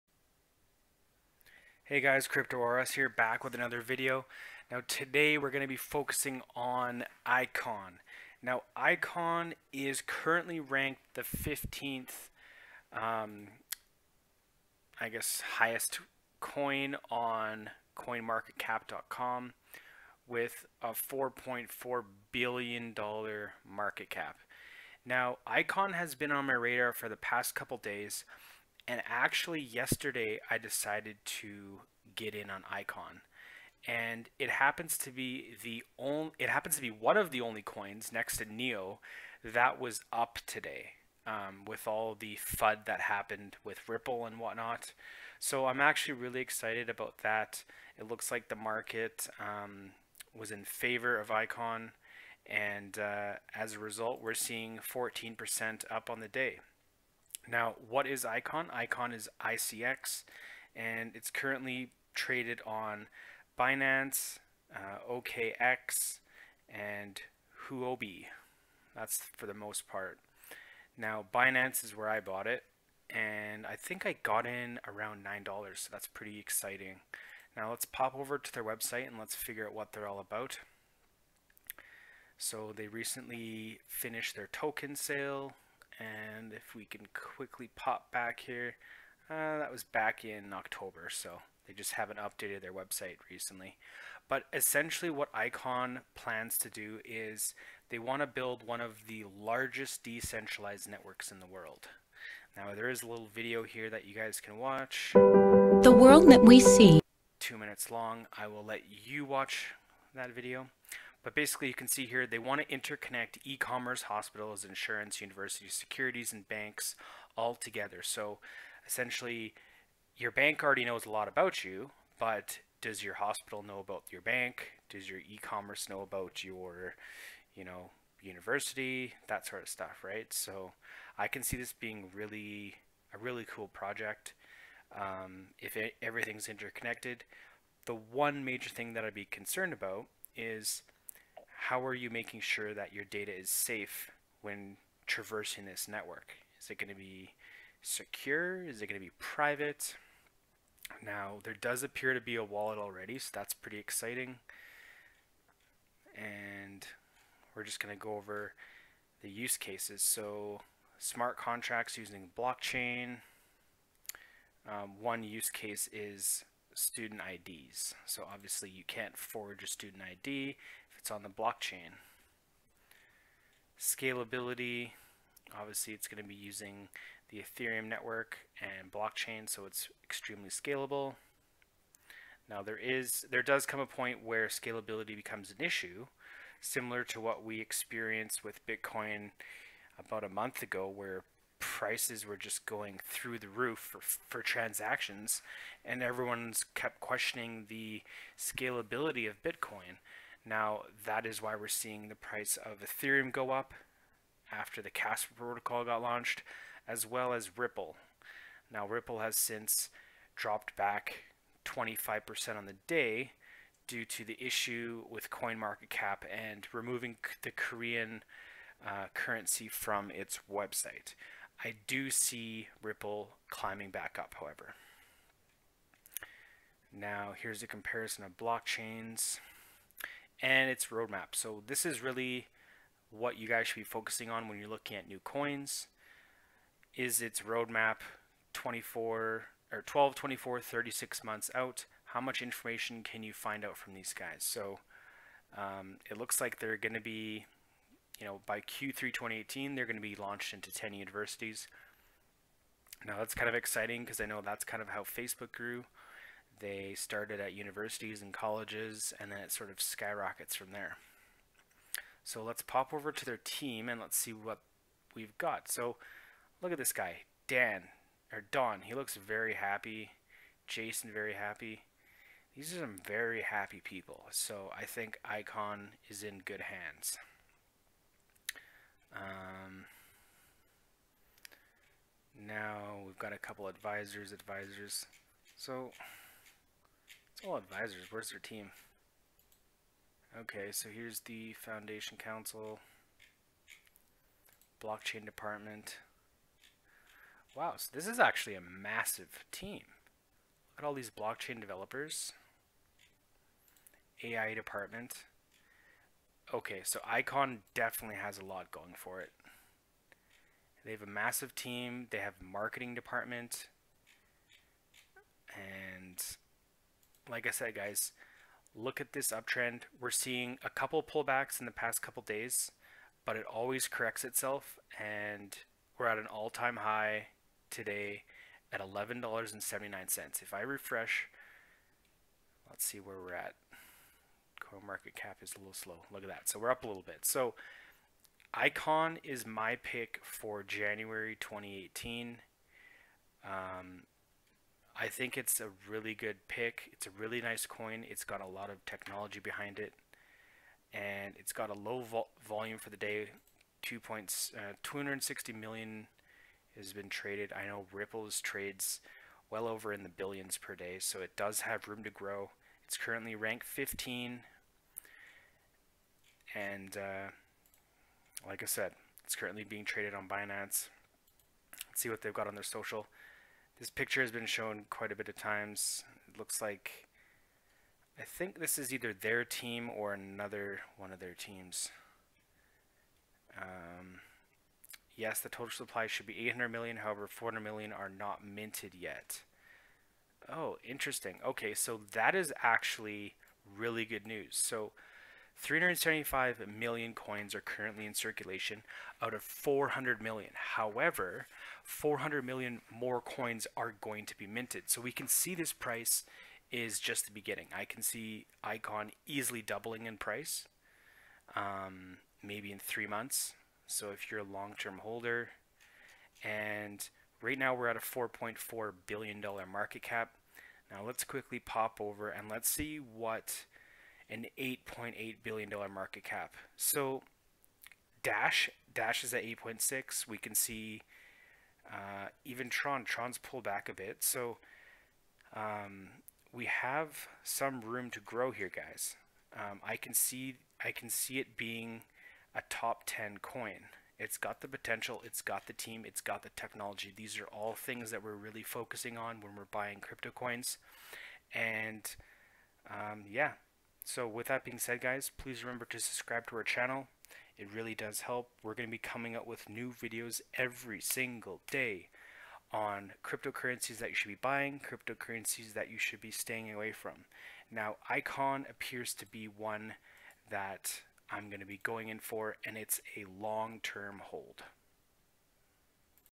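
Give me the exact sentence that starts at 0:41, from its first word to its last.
Um, with all the FUD that happened with Ripple and whatnot.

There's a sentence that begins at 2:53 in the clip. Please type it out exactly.
Scalability, obviously it's going to be using the Ethereum network and blockchain, so it's extremely scalable.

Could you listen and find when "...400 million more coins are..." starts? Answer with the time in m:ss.
6:41.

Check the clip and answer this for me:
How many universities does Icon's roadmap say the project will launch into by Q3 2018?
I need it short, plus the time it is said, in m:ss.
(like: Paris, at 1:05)
10, at 4:10.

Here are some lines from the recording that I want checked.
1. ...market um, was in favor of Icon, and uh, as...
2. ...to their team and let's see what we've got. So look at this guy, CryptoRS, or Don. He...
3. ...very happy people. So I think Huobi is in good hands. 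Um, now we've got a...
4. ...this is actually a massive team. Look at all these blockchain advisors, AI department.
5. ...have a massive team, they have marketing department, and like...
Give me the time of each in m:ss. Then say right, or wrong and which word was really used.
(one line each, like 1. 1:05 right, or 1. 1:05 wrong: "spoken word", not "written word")
1. 0:48 right
2. 4:23 wrong: "Dan", not "CryptoRS"
3. 4:33 wrong: "Icon", not "Huobi"
4. 4:57 wrong: "developers", not "advisors"
5. 5:10 right.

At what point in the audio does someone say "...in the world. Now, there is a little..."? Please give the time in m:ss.
1:41.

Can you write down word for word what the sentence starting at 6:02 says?
It's currently ranked 15, and uh, like I said, it's currently being traded on Binance.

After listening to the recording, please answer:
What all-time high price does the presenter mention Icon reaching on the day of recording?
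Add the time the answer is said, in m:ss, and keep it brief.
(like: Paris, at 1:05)
$11.79, at 5:28.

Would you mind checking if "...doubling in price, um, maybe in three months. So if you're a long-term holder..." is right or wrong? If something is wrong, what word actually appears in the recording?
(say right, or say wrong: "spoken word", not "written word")
right.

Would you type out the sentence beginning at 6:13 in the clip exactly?
This picture has been shown quite a bit of times.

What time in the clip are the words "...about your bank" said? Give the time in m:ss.
2:03.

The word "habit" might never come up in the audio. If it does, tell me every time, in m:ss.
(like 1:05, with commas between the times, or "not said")
not said.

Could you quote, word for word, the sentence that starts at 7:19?
Um, I can see I can see it being a top 10 coin.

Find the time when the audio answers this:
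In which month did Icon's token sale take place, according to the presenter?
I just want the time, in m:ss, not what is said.
1:30.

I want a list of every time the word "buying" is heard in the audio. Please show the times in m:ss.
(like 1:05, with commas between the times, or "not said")
7:29, 7:44.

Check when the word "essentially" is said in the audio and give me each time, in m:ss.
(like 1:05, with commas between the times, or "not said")
1:34, 1:58.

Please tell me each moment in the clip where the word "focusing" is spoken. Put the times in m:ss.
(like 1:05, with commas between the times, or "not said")
0:05, 3:53, 7:28.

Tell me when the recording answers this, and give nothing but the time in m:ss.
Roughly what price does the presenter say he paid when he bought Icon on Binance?
1:15.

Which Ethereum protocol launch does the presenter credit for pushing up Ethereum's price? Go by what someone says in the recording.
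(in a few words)
Casper.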